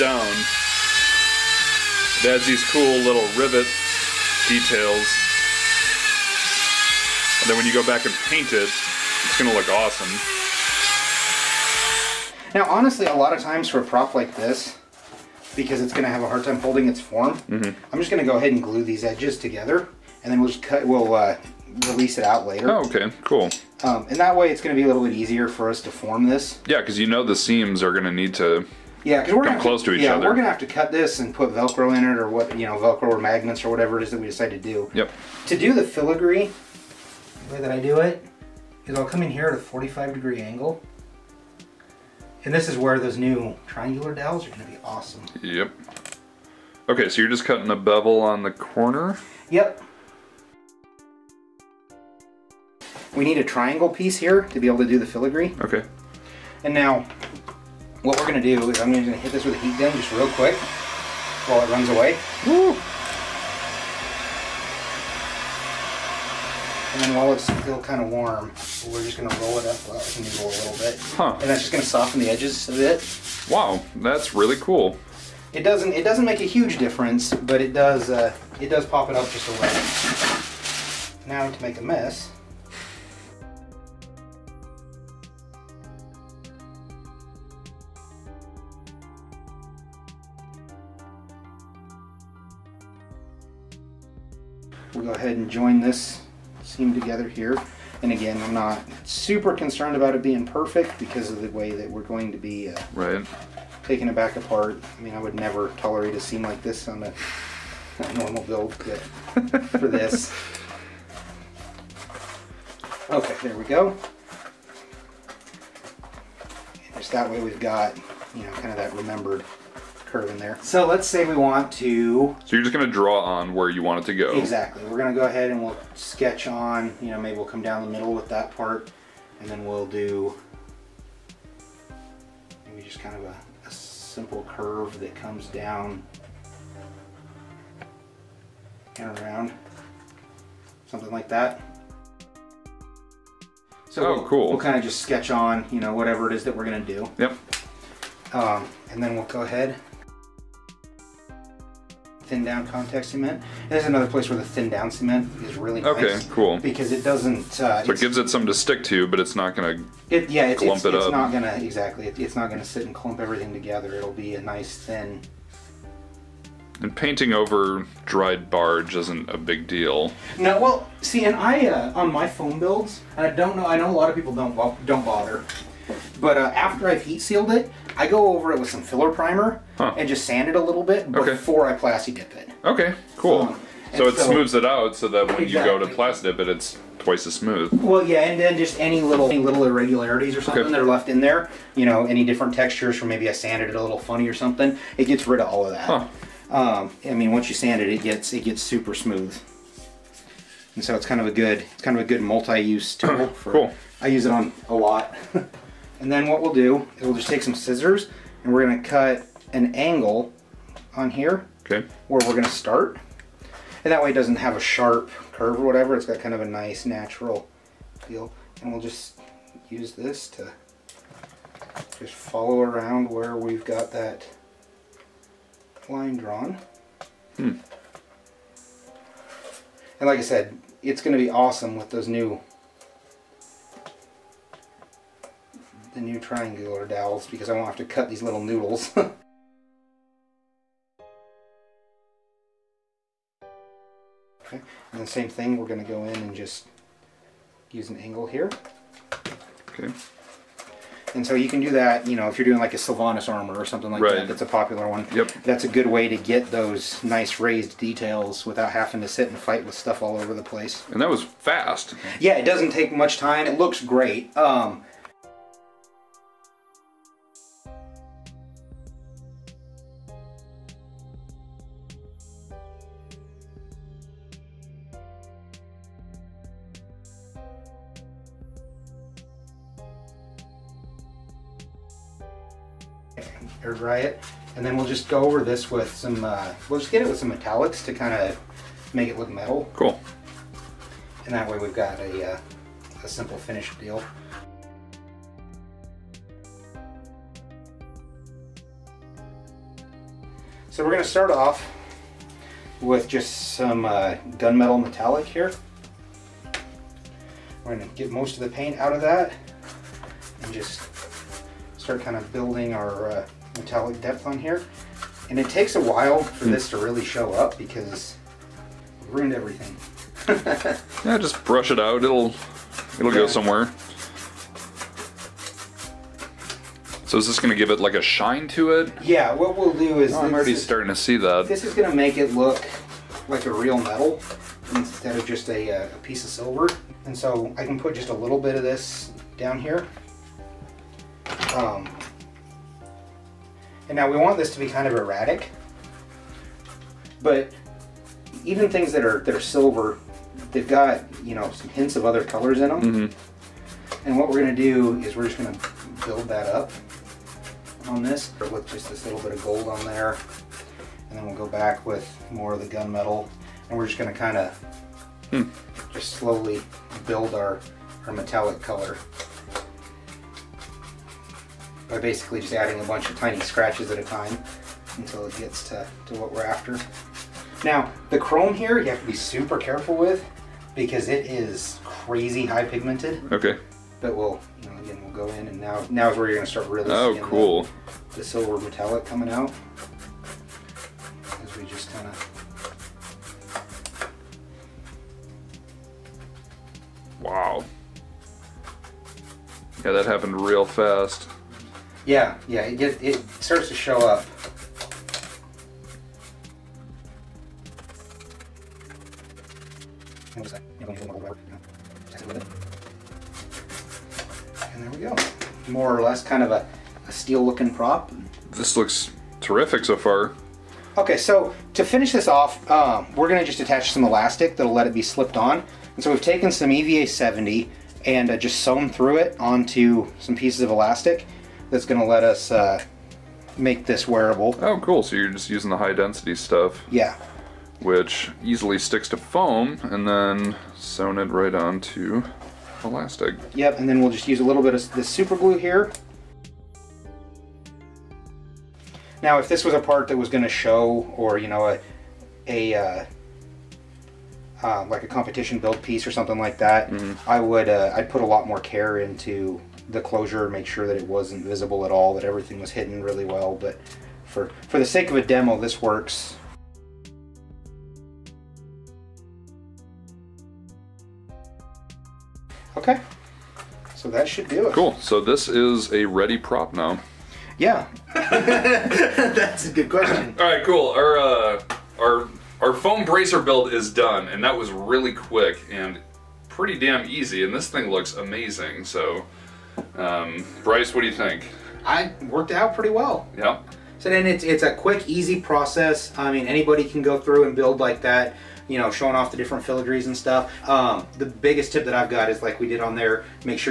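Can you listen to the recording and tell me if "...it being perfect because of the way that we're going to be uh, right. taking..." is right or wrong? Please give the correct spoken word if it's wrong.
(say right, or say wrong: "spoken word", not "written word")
right.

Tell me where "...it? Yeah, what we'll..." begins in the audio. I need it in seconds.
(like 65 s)
328 s.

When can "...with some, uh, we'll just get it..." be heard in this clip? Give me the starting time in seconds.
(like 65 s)
285 s.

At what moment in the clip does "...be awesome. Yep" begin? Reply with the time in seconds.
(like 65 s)
44 s.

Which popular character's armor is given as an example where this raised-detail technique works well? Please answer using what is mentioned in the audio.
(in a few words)
Sylvanas.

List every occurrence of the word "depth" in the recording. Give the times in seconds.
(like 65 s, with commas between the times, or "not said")
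314 s.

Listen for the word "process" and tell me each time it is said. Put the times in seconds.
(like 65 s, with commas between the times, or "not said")
495 s.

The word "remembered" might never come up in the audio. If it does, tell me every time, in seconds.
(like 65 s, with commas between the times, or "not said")
118 s.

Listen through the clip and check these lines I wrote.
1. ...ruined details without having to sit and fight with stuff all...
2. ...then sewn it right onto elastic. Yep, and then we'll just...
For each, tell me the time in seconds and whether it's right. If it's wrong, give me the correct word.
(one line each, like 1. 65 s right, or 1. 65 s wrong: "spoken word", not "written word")
1. 257 s wrong: "raised", not "ruined"
2. 440 s right.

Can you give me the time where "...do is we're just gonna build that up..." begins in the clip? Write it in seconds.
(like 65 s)
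354 s.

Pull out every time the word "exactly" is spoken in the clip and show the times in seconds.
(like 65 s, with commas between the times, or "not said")
124 s, 161 s, 185 s.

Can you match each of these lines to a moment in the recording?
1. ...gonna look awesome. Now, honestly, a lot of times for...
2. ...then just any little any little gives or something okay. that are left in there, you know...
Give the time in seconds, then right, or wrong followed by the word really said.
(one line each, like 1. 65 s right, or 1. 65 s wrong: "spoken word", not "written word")
1. 9 s right
2. 188 s wrong: "irregularities", not "gives".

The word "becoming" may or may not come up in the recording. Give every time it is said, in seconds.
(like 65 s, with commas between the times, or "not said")
not said.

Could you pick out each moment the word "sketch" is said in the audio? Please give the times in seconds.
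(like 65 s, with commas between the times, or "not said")
125 s, 144 s.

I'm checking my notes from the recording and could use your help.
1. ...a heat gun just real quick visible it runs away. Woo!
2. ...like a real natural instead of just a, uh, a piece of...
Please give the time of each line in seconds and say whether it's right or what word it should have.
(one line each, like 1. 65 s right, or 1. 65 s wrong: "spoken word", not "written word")
1. 59 s wrong: "while", not "visible"
2. 333 s wrong: "metal", not "natural".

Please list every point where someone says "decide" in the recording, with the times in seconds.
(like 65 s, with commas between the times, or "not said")
34 s.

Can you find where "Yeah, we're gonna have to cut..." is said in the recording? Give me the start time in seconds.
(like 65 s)
30 s.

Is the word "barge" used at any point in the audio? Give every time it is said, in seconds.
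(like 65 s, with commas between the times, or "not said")
168 s.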